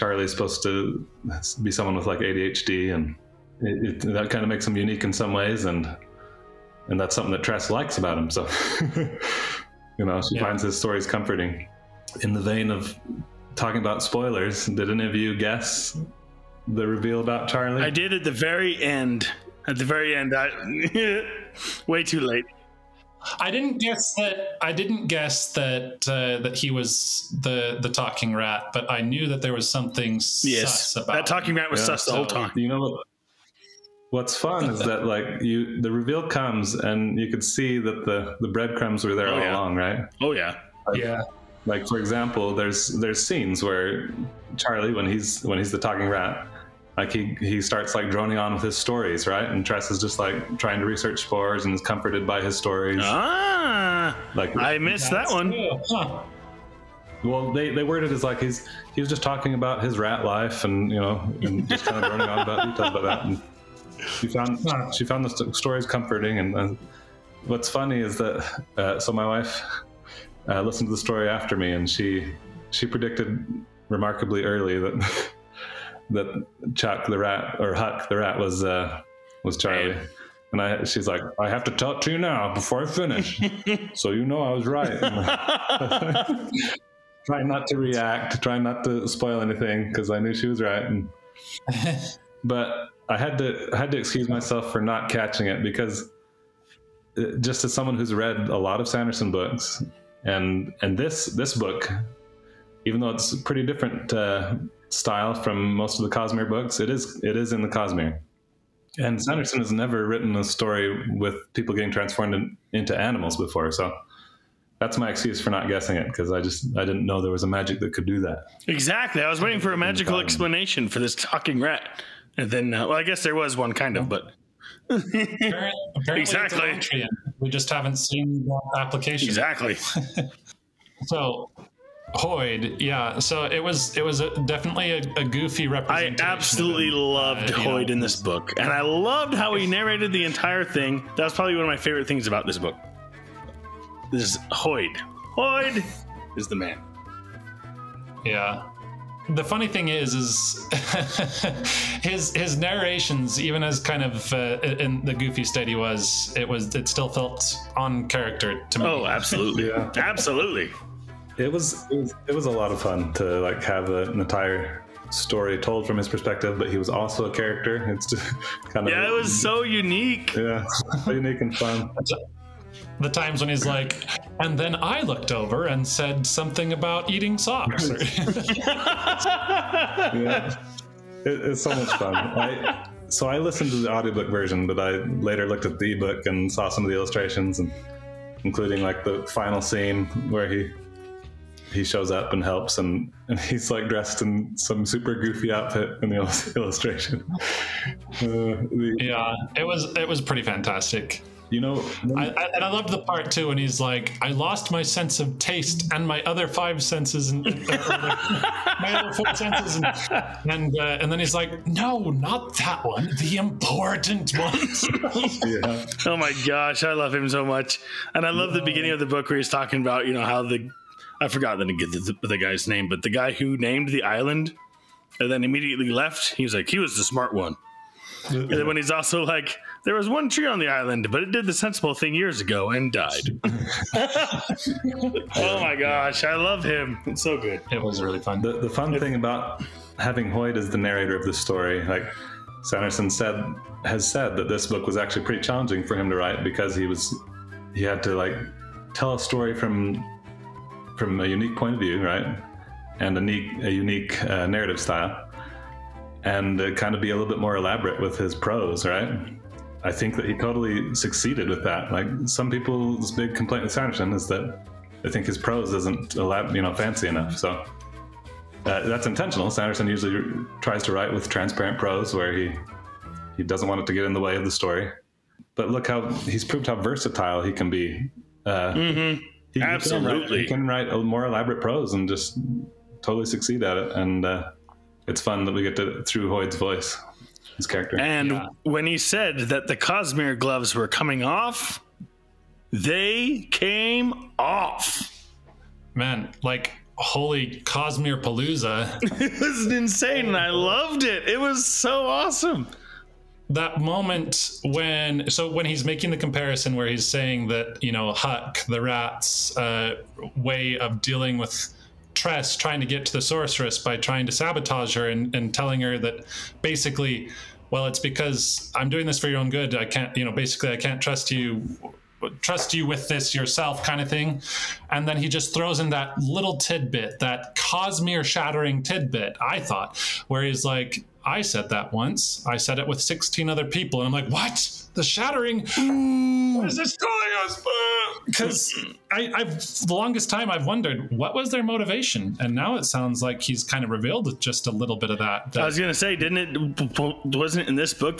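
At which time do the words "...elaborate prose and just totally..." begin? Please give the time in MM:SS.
04:41.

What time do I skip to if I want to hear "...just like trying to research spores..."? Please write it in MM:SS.
00:49.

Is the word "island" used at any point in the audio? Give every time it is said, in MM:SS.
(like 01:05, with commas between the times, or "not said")
03:44, 03:50.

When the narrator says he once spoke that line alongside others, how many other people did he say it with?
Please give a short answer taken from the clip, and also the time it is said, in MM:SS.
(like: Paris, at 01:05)
16, at 05:32.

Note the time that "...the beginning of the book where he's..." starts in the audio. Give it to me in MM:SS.
03:38.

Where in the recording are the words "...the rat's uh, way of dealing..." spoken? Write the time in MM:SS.
05:08.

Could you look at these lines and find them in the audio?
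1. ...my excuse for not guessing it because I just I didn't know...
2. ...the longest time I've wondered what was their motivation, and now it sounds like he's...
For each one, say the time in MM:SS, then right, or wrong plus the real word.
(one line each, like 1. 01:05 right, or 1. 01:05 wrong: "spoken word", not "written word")
1. 01:54 right
2. 05:39 right.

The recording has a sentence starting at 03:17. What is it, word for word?
Uh, the, yeah, it was it was pretty fantastic.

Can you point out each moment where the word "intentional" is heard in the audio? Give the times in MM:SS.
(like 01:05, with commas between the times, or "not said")
04:29.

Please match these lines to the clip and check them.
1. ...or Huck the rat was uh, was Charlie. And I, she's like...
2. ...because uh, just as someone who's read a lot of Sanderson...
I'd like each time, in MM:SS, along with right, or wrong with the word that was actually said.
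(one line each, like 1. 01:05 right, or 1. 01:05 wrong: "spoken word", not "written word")
1. 01:17 right
2. 01:35 right.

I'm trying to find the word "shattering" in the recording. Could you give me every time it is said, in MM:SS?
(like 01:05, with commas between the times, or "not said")
05:28, 05:35.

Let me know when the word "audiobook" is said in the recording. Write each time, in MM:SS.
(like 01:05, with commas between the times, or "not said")
03:03.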